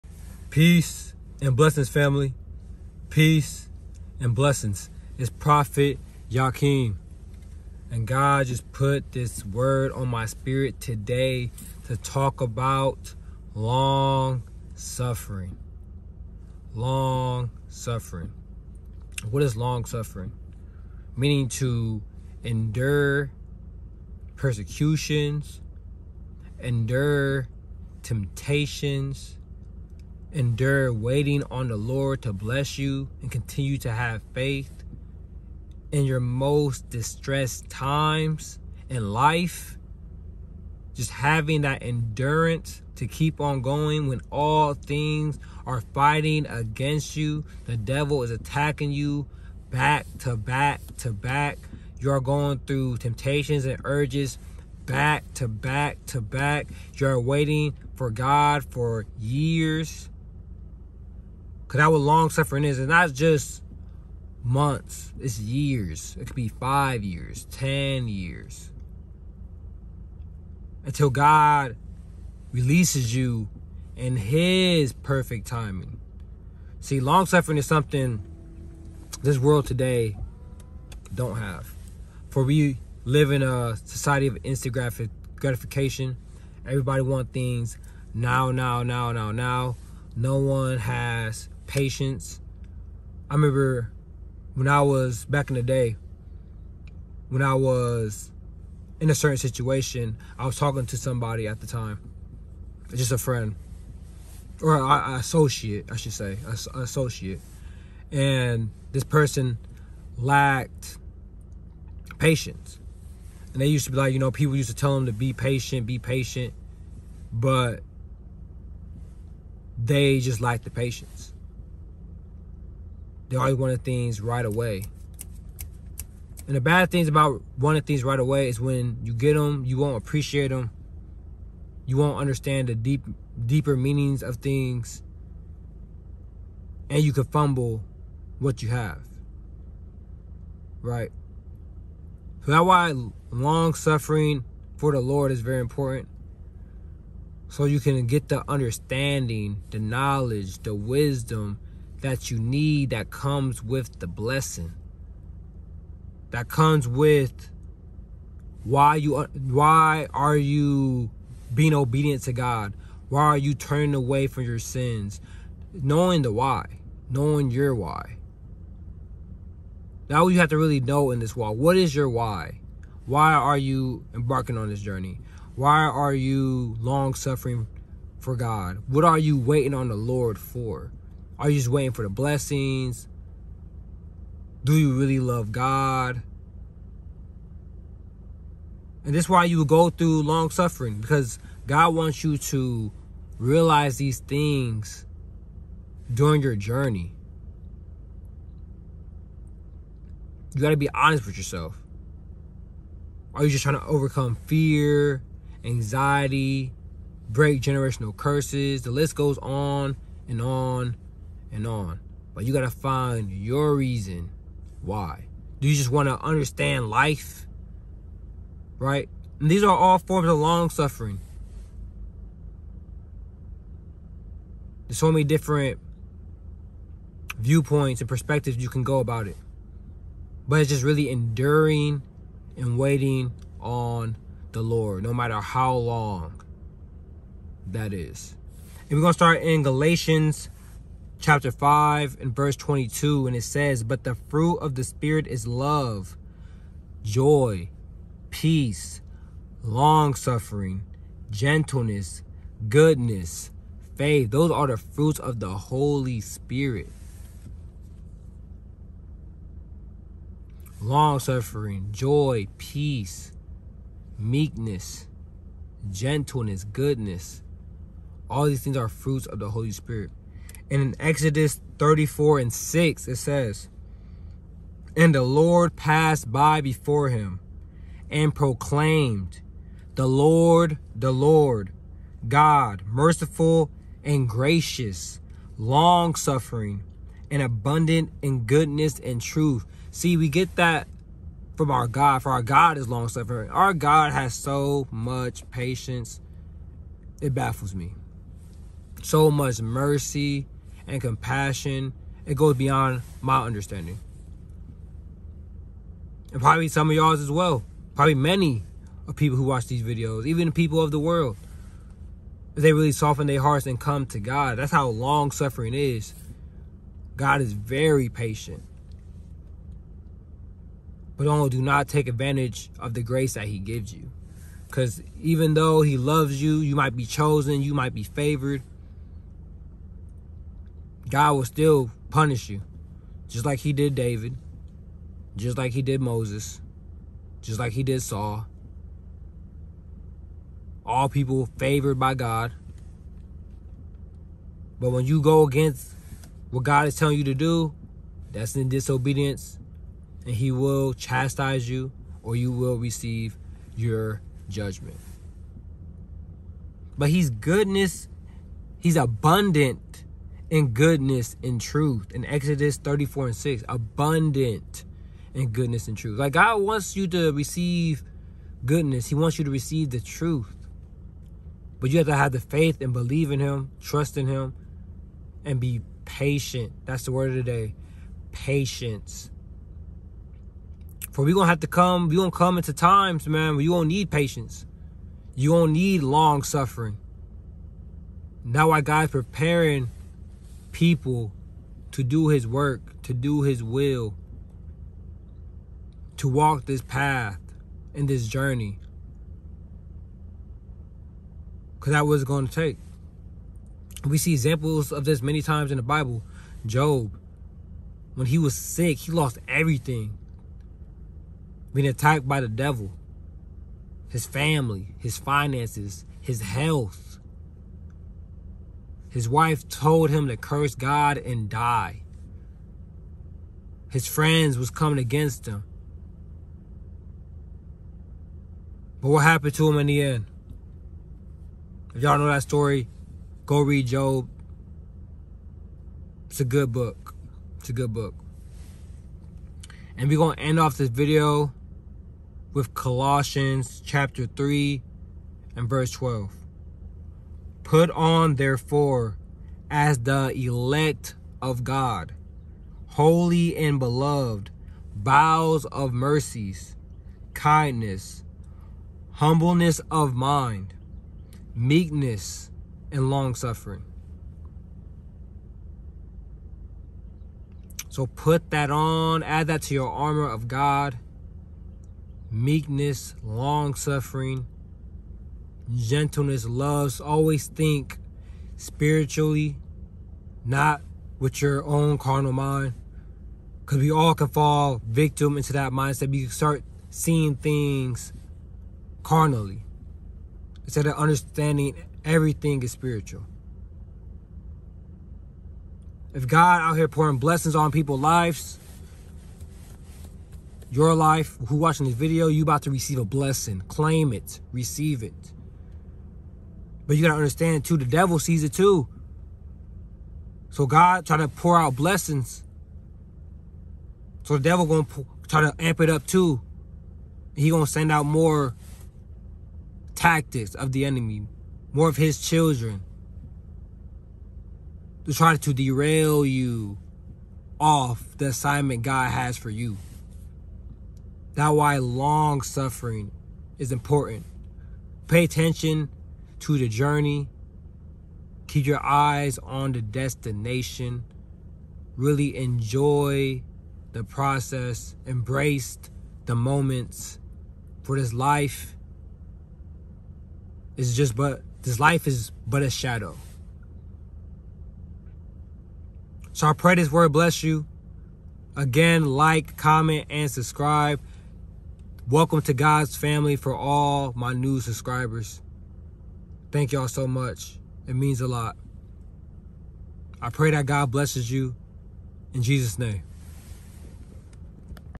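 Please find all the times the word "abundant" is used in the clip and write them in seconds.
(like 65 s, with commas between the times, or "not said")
287 s, 358 s, 363 s.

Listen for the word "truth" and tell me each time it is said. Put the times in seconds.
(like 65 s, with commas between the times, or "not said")
289 s, 361 s, 365 s, 370 s.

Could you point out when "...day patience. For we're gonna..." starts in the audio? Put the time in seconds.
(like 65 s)
377 s.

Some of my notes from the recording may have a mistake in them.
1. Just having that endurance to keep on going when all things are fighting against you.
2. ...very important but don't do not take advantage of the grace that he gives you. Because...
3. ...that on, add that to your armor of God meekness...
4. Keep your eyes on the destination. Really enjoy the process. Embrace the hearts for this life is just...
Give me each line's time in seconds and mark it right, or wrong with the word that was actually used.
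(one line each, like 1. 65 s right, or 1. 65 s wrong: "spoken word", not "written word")
1. 40 s right
2. 317 s wrong: "patient", not "important"
3. 468 s right
4. 538 s wrong: "moments", not "hearts".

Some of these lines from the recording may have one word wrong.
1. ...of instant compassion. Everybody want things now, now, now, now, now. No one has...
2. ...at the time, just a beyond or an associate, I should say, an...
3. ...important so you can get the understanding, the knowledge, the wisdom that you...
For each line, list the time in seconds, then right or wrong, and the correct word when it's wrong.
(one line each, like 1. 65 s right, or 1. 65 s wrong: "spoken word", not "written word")
1. 84 s wrong: "gratification", not "compassion"
2. 101 s wrong: "friend", not "beyond"
3. 145 s right.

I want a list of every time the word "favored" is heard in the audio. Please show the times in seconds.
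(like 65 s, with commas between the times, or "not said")
328 s, 341 s.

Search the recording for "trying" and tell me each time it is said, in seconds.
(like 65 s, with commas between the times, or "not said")
203 s, 511 s.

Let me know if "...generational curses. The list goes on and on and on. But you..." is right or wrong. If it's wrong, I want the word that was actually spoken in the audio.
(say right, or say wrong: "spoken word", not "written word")
right.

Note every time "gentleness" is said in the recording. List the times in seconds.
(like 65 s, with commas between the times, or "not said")
251 s, 265 s, 475 s.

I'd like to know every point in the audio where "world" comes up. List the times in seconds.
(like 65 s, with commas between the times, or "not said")
79 s, 310 s.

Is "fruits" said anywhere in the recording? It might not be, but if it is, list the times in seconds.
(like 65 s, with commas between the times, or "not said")
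244 s, 254 s, 268 s.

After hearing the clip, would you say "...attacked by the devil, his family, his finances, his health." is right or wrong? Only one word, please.
right.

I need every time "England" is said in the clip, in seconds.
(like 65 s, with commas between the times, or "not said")
not said.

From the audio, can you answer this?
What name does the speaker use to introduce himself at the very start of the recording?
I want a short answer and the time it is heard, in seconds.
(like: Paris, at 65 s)
Prophet Yakim, at 5 s.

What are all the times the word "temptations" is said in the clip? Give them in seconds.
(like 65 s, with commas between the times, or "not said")
28 s, 52 s.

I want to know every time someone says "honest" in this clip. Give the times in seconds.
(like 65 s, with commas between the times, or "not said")
200 s.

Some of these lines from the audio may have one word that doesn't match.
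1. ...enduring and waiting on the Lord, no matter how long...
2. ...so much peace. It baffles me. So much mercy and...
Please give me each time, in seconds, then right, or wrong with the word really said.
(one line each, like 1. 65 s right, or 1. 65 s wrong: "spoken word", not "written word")
1. 231 s right
2. 294 s wrong: "patience", not "peace".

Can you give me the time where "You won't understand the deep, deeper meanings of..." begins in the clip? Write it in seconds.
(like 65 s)
131 s.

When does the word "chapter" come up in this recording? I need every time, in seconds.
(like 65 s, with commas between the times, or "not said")
241 s, 443 s.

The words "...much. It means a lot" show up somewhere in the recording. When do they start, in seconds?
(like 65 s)
567 s.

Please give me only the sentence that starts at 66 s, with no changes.
It could be five years, 10 years.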